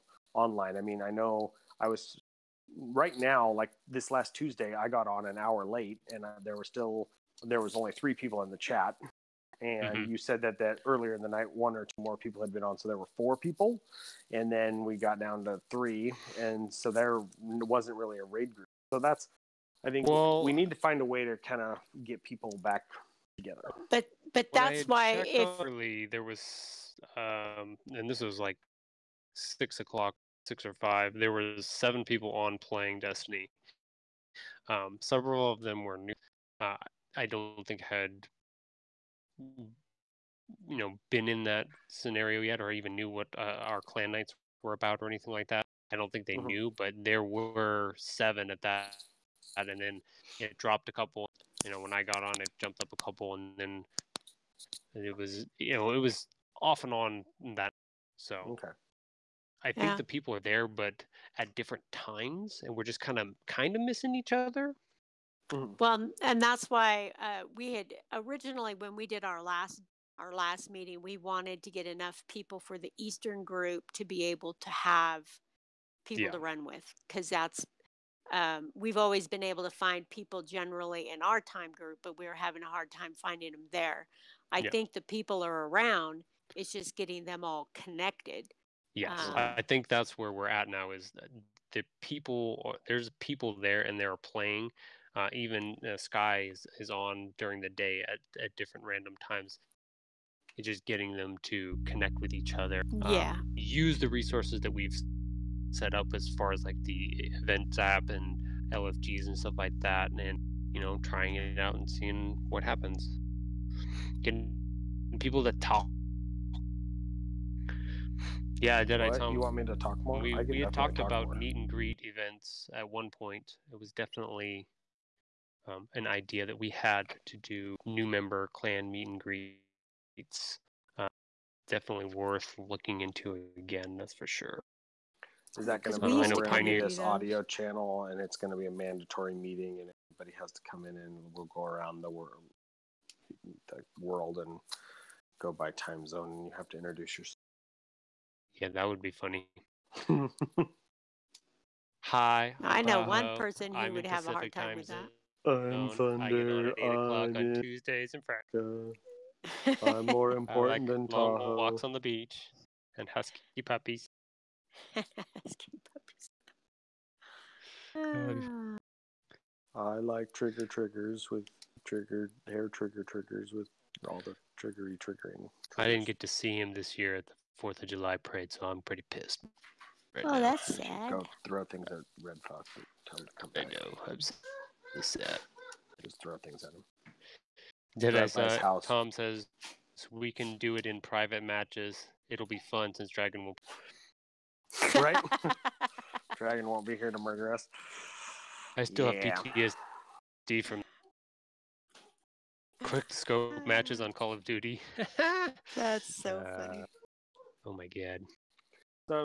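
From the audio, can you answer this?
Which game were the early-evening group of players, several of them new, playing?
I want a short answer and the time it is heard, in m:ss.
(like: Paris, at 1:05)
Destiny, at 0:32.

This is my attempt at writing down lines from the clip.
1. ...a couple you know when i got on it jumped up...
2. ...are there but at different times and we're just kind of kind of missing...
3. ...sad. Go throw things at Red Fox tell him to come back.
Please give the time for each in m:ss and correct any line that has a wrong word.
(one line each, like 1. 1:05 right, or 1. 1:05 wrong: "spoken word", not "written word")
1. 0:50 right
2. 1:00 right
3. 3:00 right.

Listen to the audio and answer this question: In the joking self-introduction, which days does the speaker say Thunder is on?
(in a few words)
Tuesdays and Fridays.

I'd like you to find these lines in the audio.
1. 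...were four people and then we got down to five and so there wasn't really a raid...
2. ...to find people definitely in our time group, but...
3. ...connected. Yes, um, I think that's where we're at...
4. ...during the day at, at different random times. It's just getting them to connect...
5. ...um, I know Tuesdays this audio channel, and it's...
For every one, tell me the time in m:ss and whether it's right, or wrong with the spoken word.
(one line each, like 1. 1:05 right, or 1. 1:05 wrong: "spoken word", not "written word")
1. 0:12 wrong: "three", not "five"
2. 1:19 wrong: "generally", not "definitely"
3. 1:27 right
4. 1:37 right
5. 2:16 wrong: "Pioneer", not "Tuesdays".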